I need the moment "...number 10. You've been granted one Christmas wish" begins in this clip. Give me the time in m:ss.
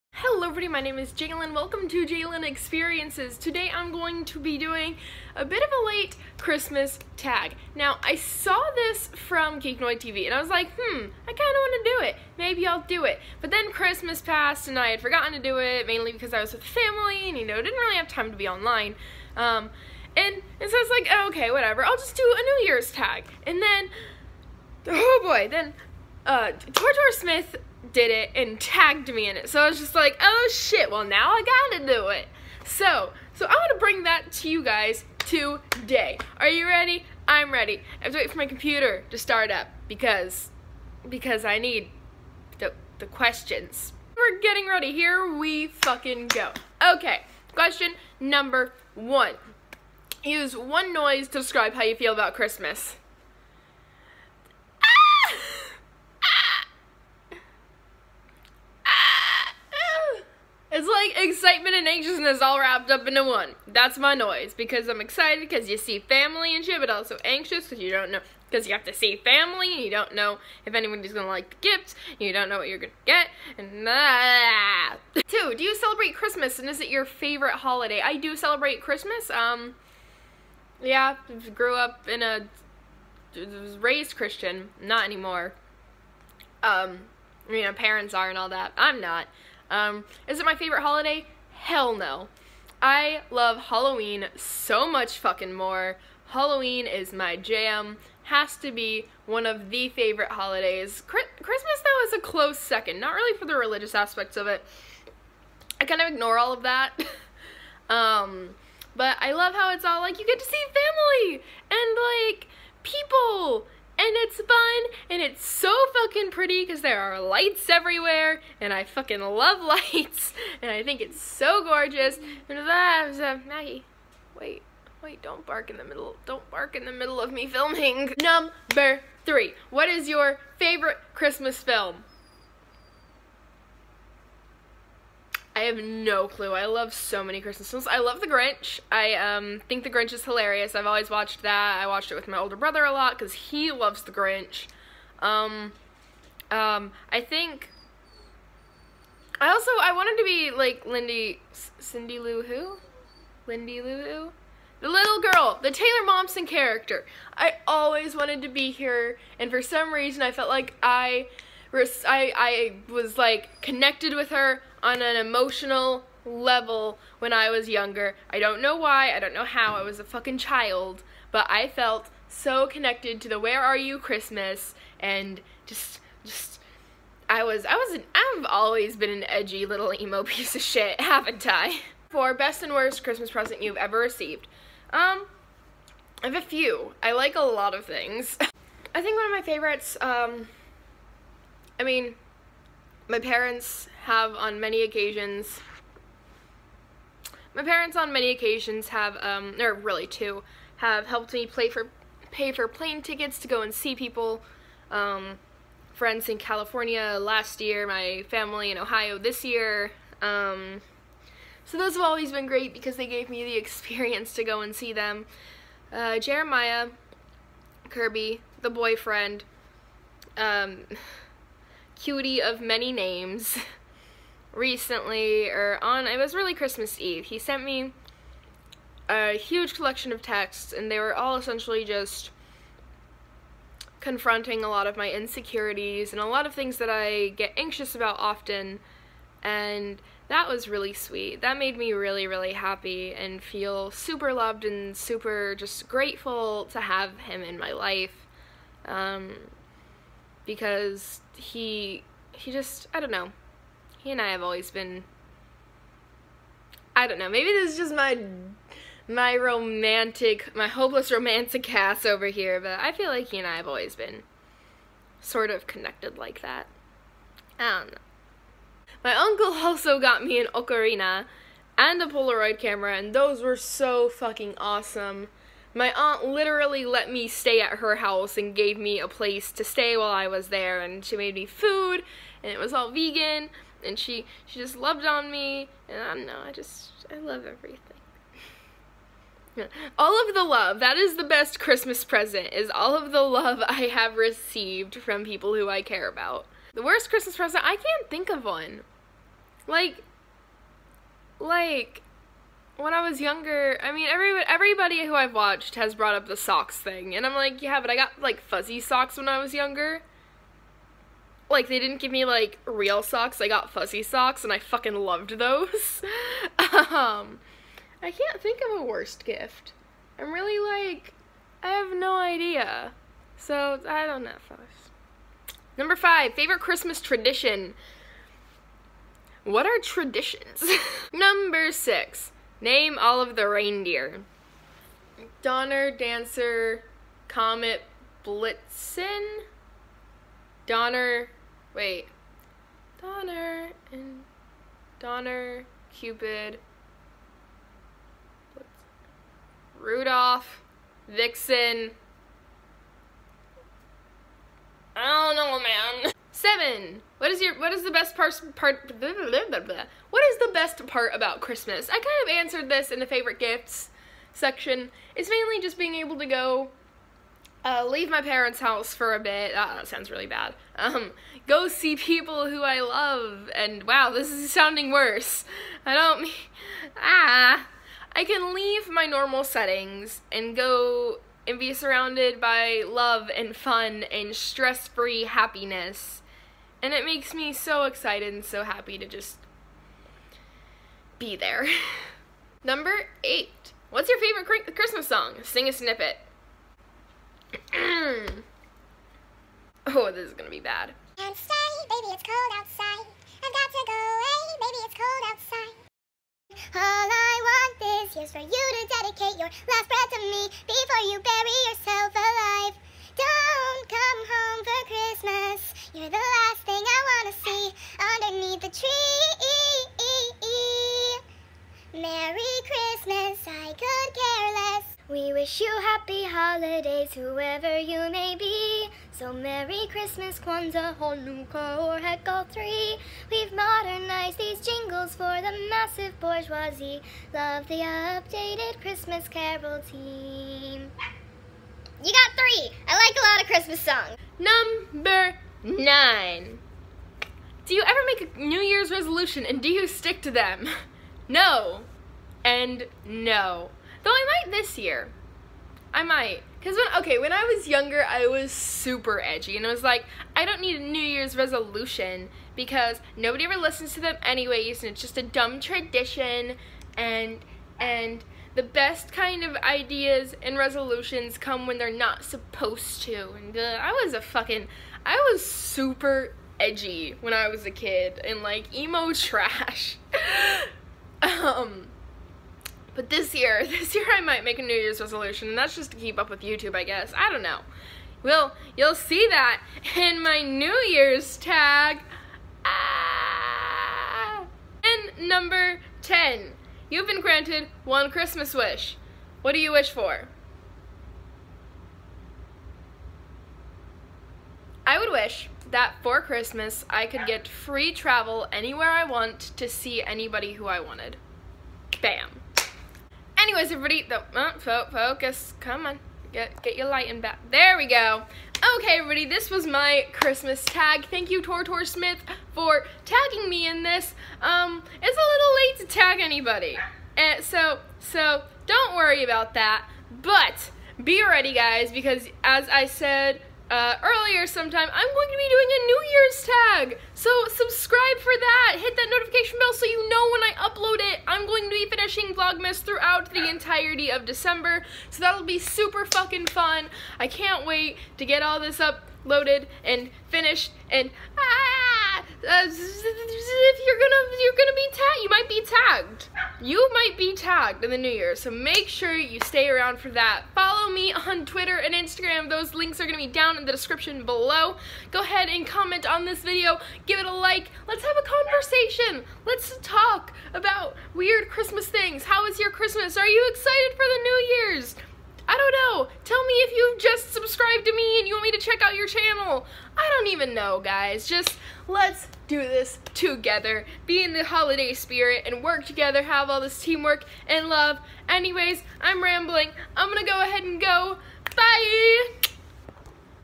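8:15.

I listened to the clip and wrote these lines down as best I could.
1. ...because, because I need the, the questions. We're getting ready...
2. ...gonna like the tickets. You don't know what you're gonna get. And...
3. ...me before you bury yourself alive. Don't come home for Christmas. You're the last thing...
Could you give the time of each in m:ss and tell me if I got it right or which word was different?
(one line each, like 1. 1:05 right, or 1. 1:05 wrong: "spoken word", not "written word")
1. 0:39 right
2. 1:11 wrong: "gifts", not "tickets"
3. 6:50 right.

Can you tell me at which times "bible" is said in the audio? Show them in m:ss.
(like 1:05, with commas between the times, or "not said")
not said.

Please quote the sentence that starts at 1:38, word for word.
Has to be one of the favorite holidays.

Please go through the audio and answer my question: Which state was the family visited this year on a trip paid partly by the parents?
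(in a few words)
Ohio.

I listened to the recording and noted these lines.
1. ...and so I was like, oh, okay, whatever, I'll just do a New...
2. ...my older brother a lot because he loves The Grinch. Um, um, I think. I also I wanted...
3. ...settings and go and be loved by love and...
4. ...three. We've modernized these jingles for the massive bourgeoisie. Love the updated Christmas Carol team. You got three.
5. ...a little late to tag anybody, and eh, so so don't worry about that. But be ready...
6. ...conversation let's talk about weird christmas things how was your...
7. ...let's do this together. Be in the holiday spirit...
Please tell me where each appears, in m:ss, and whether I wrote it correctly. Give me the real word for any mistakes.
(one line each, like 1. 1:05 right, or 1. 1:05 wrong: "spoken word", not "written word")
1. 0:20 right
2. 2:22 right
3. 6:19 wrong: "surrounded", not "loved"
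4. 7:12 right
5. 8:45 right
6. 9:28 right
7. 9:41 right.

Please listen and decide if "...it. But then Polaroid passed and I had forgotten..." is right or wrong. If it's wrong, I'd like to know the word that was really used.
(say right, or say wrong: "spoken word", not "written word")
wrong: "Christmas", not "Polaroid".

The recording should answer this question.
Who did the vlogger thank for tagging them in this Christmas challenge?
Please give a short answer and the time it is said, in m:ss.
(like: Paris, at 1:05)
Tortor Smith, at 8:41.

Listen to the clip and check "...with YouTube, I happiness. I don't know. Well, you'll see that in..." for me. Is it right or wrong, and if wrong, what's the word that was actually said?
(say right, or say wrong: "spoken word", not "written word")
wrong: "guess", not "happiness".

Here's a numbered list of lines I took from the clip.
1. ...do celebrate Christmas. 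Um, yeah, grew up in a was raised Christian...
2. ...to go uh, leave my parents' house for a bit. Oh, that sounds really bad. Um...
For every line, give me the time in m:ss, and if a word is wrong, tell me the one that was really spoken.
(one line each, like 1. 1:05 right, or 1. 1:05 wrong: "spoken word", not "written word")
1. 1:18 right
2. 6:06 right.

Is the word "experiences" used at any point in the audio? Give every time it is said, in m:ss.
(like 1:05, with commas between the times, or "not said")
0:02, 3:33.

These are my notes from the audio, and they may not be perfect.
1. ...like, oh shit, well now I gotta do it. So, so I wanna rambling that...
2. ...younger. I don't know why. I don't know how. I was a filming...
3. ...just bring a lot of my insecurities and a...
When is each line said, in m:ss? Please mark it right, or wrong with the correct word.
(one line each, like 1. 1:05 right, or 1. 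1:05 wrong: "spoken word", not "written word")
1. 0:29 wrong: "bring", not "rambling"
2. 2:47 wrong: "fucking", not "filming"
3. 3:51 wrong: "confronting", not "bring".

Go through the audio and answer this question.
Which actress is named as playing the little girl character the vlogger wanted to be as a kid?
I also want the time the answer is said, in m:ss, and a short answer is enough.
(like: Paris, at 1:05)
Taylor Momsen, at 2:35.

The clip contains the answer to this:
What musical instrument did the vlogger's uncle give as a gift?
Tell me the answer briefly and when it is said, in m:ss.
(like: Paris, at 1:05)
An ocarina, at 4:30.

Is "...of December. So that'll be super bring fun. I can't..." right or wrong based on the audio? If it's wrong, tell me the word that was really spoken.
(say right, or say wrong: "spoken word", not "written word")
wrong: "fucking", not "bring".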